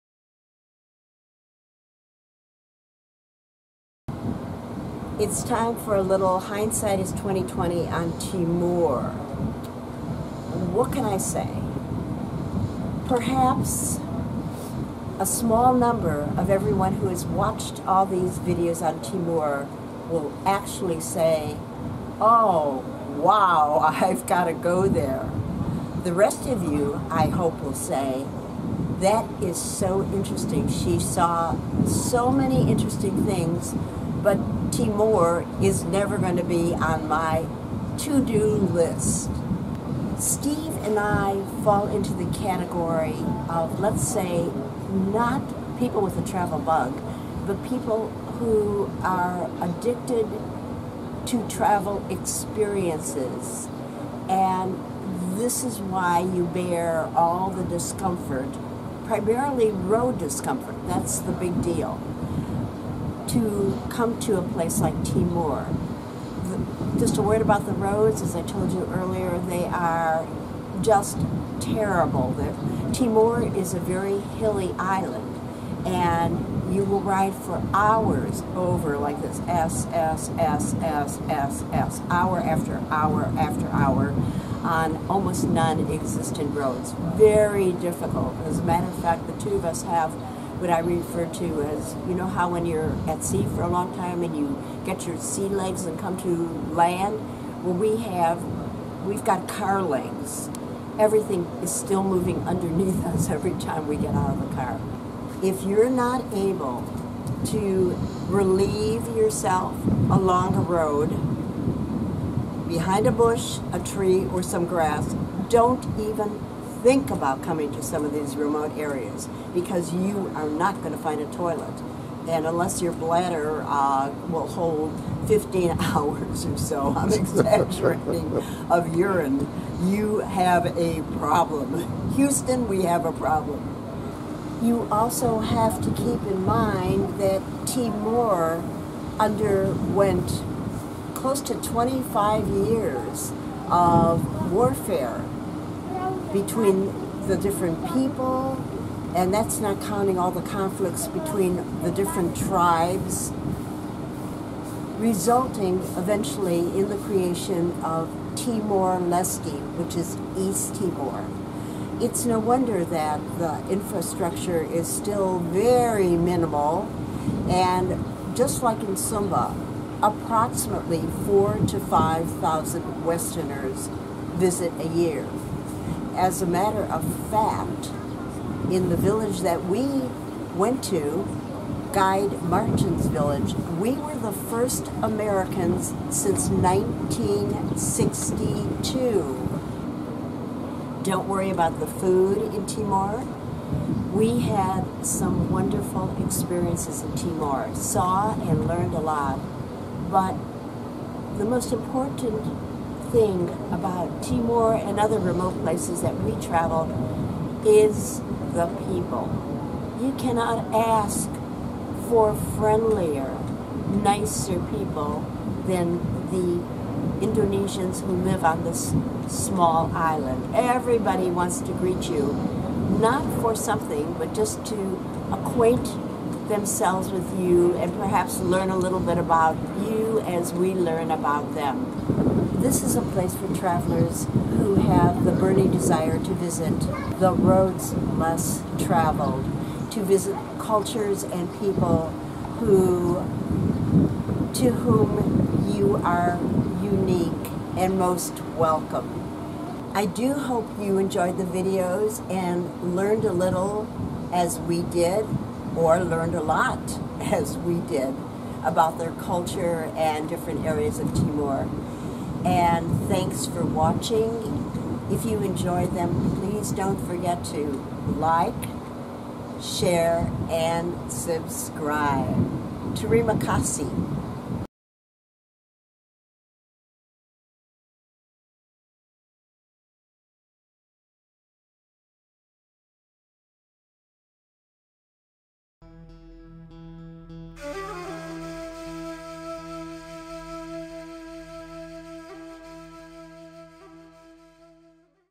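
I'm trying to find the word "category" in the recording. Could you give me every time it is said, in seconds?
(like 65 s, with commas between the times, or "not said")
42 s.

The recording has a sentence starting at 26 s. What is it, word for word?
The rest of you, I hope, will say, that is so interesting.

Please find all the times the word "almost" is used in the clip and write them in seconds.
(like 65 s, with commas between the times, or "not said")
85 s.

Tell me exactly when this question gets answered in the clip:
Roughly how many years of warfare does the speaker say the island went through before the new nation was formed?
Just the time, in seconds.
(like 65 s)
141 s.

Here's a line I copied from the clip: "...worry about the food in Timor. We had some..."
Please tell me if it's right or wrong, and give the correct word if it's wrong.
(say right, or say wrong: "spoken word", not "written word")
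right.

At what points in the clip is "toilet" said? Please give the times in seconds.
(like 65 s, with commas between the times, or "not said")
121 s.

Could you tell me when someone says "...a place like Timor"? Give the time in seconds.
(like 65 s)
64 s.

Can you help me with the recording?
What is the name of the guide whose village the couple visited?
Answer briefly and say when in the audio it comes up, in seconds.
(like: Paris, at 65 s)
Martin, at 182 s.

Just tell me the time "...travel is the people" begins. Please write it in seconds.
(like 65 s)
206 s.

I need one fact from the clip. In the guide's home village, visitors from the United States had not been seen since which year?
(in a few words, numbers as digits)
1962.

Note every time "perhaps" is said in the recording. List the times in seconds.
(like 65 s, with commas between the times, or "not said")
13 s, 227 s.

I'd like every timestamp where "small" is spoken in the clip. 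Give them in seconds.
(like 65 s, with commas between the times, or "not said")
15 s, 219 s.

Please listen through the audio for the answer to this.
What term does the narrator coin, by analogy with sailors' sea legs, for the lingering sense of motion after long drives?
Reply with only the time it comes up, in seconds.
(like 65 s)
99 s.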